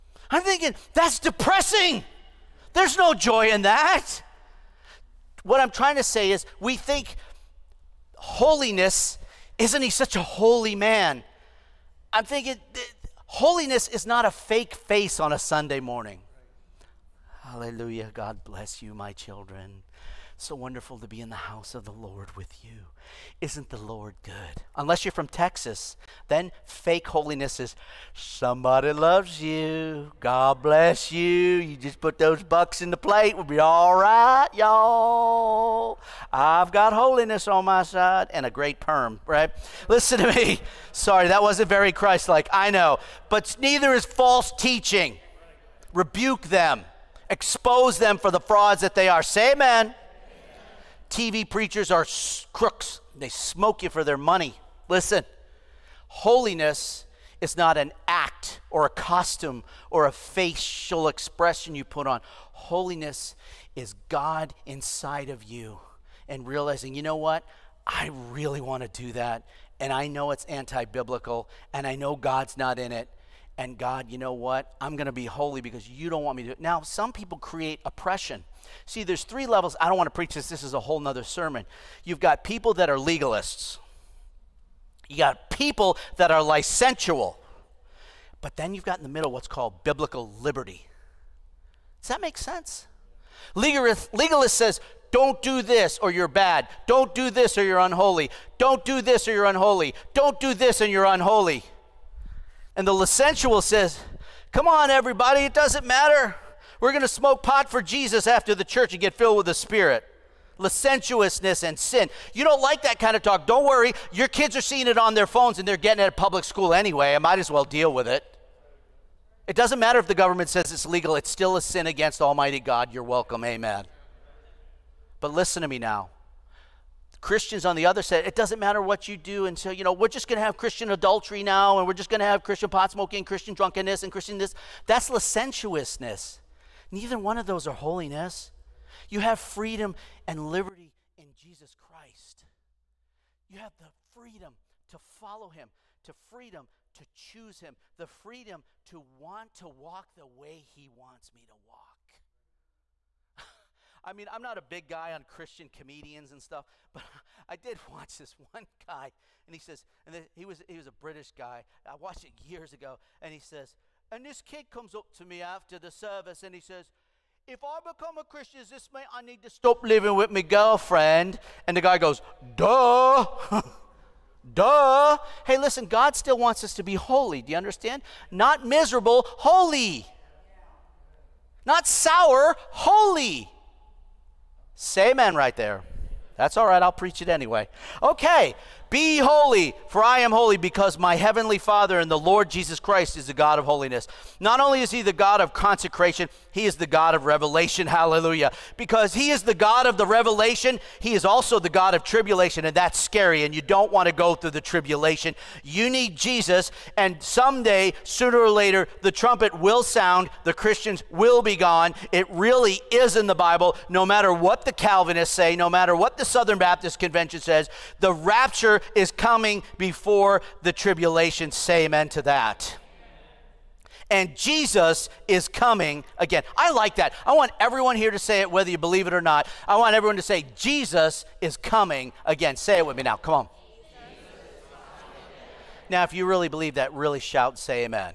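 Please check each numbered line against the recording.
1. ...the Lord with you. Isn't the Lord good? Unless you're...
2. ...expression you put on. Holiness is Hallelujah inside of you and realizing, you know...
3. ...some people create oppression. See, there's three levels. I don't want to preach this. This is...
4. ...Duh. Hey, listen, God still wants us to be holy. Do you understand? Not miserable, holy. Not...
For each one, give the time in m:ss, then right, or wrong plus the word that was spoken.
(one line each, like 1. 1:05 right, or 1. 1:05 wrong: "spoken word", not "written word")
1. 0:21 right
2. 1:01 wrong: "God", not "Hallelujah"
3. 1:16 right
4. 2:54 right.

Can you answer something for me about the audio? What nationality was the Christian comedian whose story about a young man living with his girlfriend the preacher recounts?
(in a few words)
British.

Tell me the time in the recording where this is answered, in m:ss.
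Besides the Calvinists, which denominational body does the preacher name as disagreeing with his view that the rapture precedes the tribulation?
3:36.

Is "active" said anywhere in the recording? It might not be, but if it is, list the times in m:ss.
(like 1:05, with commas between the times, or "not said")
not said.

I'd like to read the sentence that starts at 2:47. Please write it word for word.
If I become a Christian, this mean I need to stop living with my girlfriend?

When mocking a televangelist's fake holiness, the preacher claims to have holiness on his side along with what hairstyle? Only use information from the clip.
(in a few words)
A great perm.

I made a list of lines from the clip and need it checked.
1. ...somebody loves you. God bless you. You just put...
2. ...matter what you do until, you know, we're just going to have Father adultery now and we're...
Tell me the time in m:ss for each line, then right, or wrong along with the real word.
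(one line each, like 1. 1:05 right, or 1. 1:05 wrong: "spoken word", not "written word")
1. 0:28 right
2. 2:08 wrong: "Christian", not "Father".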